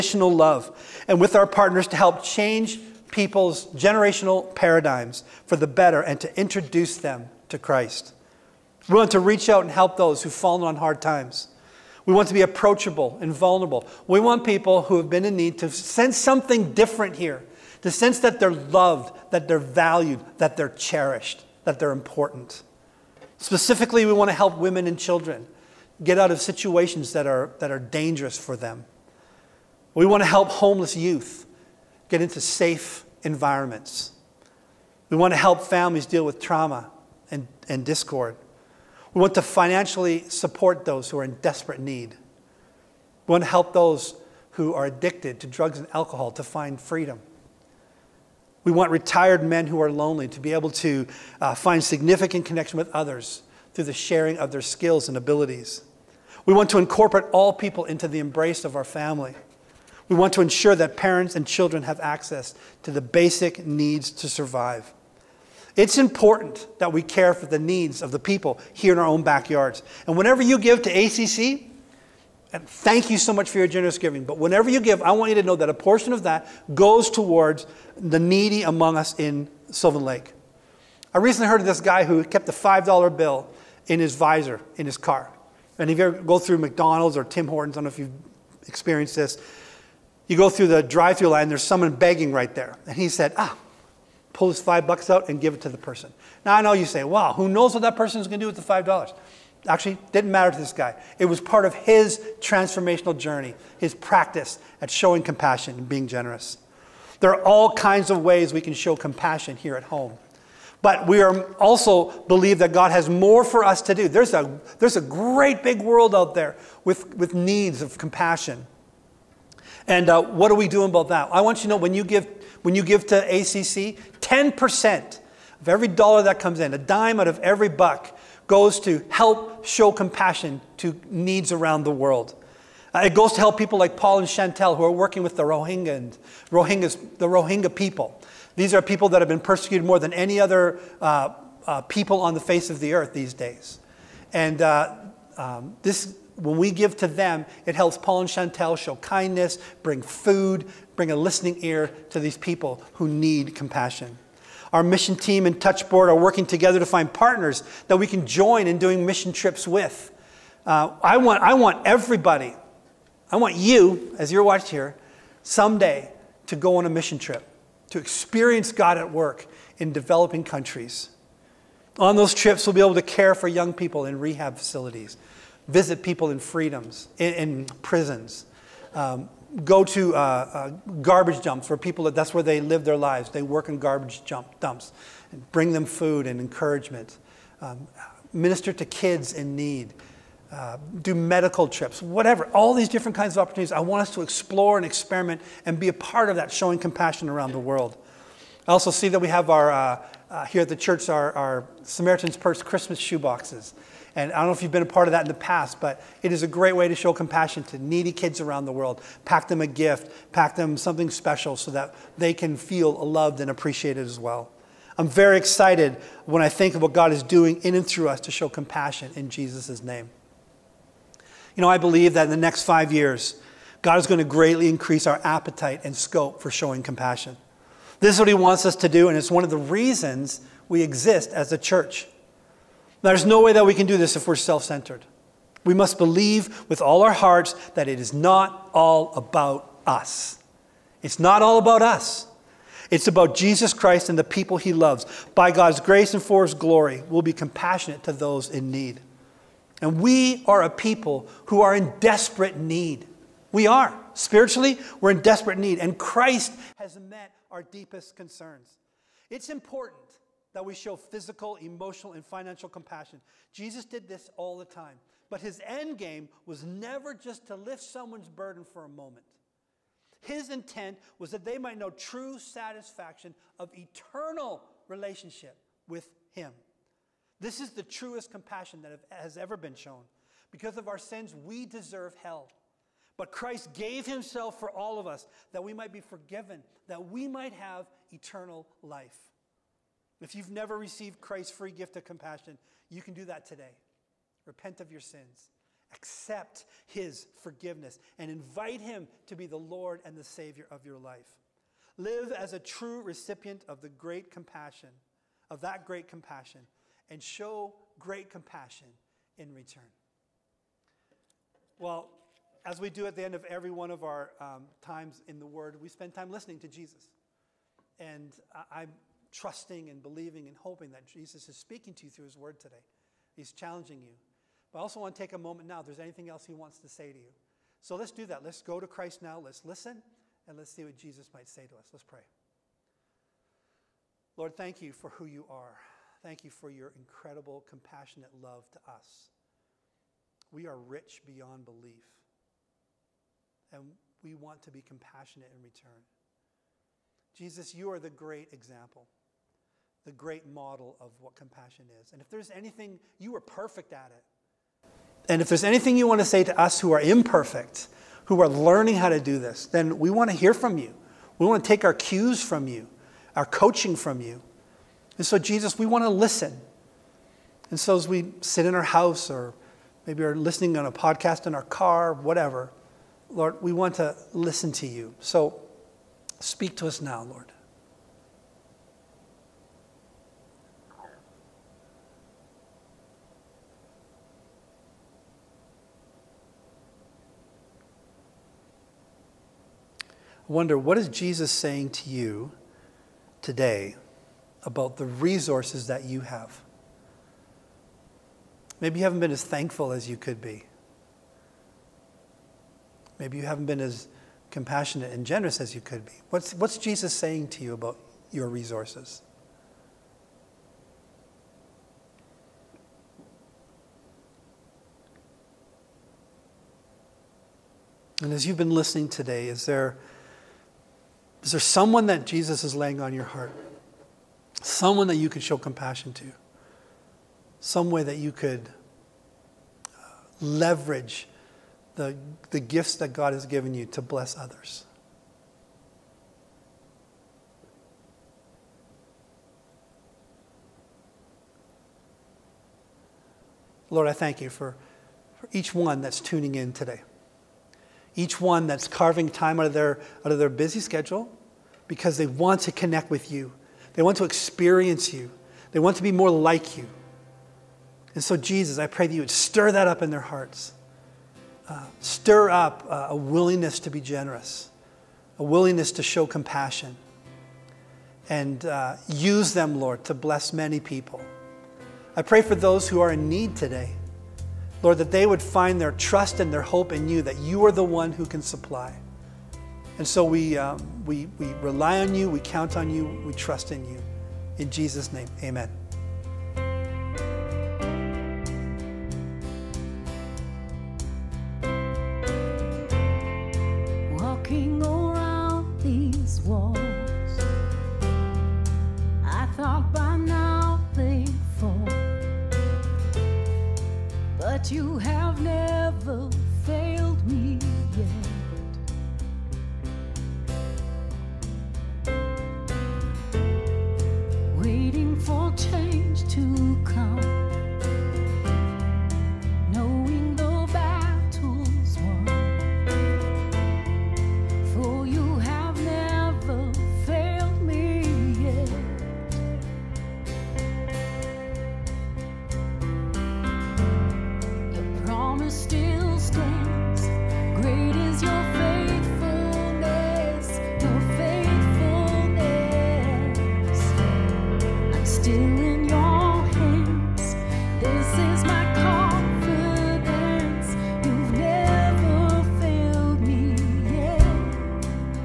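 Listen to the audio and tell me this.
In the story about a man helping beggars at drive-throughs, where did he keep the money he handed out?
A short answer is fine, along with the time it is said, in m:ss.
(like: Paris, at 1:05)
his visor, at 1:23.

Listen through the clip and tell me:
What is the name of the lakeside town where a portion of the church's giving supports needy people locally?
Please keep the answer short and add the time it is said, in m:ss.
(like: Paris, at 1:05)
Sylvan Lake, at 1:19.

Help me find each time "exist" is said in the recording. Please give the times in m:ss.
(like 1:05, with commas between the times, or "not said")
3:50.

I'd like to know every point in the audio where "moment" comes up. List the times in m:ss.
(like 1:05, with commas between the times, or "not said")
4:28, 5:25.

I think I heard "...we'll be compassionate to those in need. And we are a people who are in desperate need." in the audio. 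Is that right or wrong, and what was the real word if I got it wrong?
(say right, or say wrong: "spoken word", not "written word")
right.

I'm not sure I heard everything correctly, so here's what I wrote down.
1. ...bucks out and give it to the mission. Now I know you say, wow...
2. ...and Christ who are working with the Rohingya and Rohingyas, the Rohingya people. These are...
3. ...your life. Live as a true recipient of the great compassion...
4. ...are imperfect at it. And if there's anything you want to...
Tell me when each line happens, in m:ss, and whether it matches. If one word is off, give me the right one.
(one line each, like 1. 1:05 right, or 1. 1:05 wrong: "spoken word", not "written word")
1. 1:34 wrong: "person", not "mission"
2. 2:14 wrong: "Chantel", not "Christ"
3. 5:00 right
4. 5:53 wrong: "perfect", not "imperfect".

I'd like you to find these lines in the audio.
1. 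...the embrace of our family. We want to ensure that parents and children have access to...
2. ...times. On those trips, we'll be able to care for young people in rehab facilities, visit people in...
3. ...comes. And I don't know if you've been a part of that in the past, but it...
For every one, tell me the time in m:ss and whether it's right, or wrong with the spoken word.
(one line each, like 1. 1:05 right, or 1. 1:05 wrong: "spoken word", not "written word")
1. 0:58 right
2. 2:50 wrong: "countries", not "times"
3. 3:23 wrong: "boxes", not "comes".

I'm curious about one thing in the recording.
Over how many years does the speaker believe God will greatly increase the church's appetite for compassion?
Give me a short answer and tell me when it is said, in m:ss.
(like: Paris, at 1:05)
5, at 3:42.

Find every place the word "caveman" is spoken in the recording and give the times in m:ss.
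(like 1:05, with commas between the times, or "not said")
not said.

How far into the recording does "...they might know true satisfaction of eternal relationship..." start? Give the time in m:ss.
4:31.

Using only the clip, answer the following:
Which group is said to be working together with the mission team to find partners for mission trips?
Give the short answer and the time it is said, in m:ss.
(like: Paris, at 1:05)
Touchboard, at 2:35.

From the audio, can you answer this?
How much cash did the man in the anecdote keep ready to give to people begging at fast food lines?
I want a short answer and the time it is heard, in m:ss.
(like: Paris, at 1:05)
$5, at 1:22.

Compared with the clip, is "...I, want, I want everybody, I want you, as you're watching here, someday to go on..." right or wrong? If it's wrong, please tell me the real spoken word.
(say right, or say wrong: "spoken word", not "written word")
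right.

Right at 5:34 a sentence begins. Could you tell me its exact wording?
Lord, thank you for who you are.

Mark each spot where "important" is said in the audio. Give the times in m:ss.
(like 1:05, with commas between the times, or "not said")
0:21, 1:05, 4:19.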